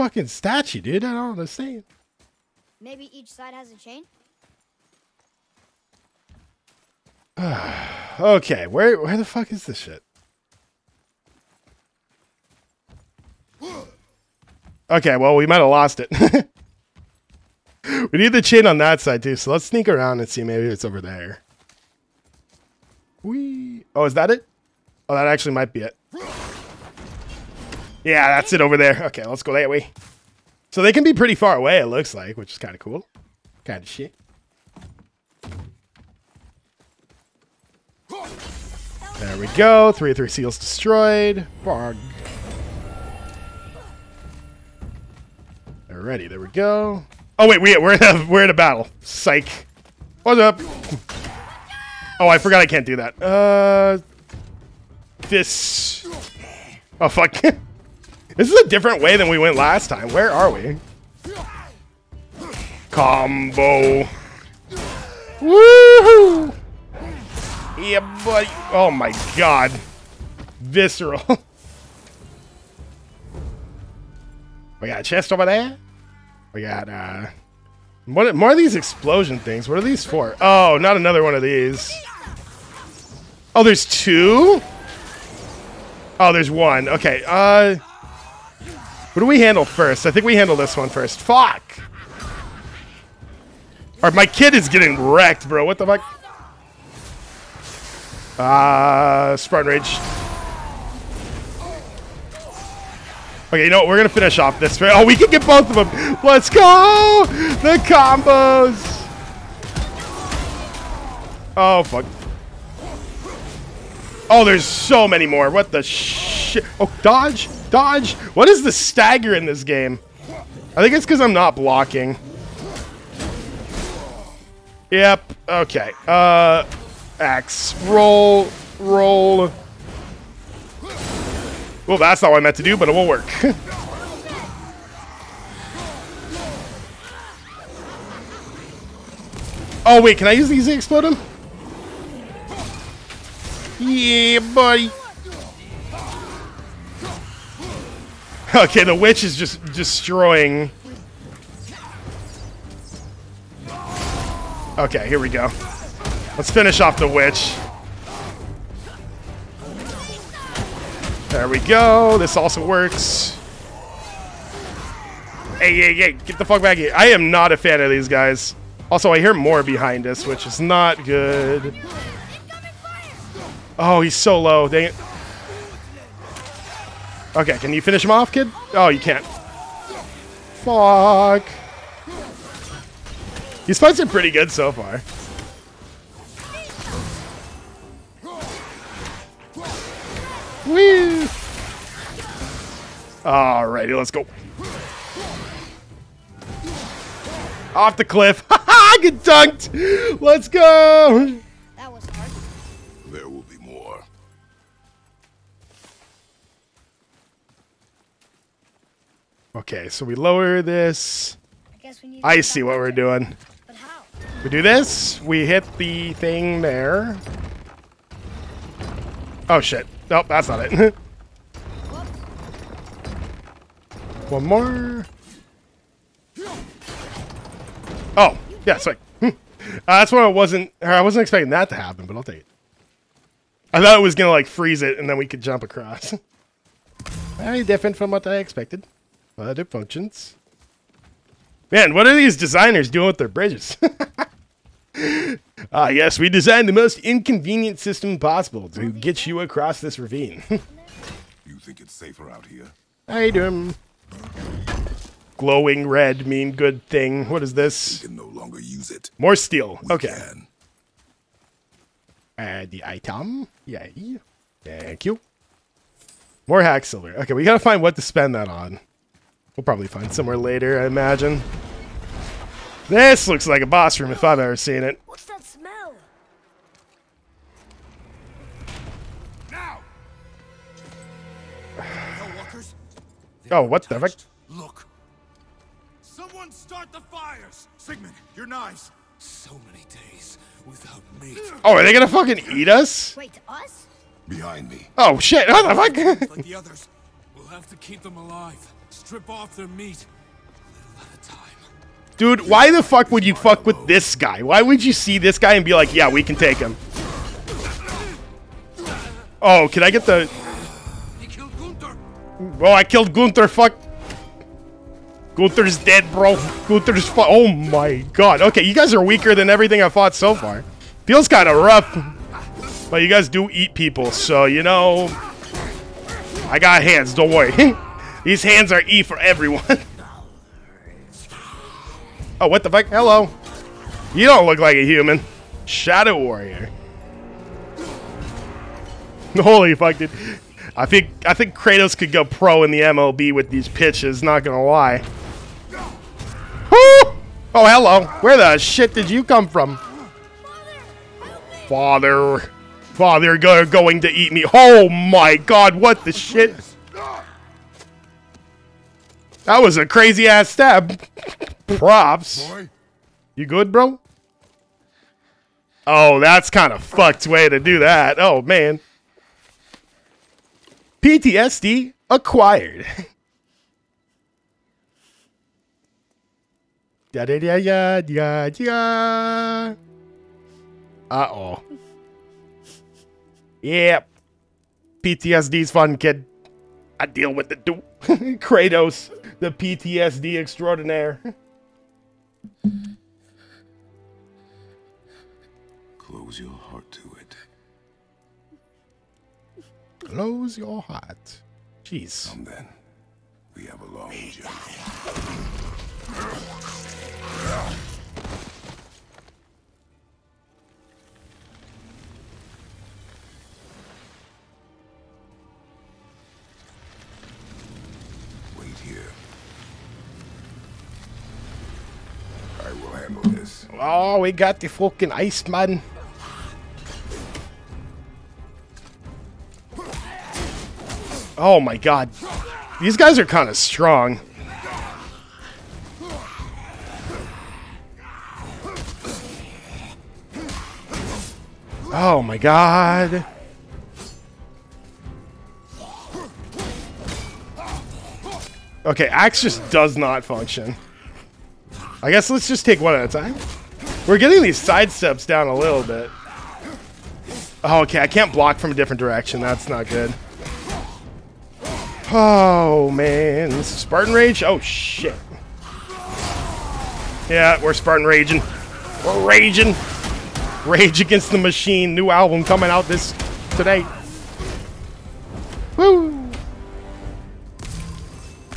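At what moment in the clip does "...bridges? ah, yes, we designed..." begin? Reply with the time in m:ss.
4:03.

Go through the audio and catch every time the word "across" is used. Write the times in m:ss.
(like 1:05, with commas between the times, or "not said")
3:55, 4:09.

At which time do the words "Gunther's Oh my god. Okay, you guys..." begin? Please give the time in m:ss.
5:16.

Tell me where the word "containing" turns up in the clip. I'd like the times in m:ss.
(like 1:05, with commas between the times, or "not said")
not said.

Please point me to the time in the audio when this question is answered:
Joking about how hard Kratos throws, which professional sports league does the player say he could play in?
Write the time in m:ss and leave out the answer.
5:42.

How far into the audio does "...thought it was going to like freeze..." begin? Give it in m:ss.
3:53.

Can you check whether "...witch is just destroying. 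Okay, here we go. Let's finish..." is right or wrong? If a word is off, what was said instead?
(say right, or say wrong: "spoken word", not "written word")
right.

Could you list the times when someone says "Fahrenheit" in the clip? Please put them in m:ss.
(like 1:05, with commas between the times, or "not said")
not said.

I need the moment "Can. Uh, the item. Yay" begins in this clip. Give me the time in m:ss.
4:20.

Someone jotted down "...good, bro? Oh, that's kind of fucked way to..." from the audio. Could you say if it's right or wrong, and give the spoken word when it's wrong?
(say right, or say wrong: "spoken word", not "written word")
right.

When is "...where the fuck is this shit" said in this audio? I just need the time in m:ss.
0:09.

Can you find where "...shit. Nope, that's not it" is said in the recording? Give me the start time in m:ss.
3:39.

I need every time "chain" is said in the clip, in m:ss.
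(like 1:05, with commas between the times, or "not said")
0:03, 0:18.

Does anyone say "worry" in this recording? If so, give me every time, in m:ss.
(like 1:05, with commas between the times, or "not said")
5:27.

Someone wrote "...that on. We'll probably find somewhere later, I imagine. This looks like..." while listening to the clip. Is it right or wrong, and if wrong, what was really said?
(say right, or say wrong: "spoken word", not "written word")
right.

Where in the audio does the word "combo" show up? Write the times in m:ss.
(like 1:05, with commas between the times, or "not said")
1:02, 1:47.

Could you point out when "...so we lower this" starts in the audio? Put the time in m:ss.
3:29.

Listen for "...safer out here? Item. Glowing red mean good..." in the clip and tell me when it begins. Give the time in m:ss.
4:11.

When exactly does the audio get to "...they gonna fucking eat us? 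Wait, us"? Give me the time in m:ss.
4:51.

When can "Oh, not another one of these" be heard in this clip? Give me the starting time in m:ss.
1:20.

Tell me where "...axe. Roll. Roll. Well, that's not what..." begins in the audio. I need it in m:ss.
2:07.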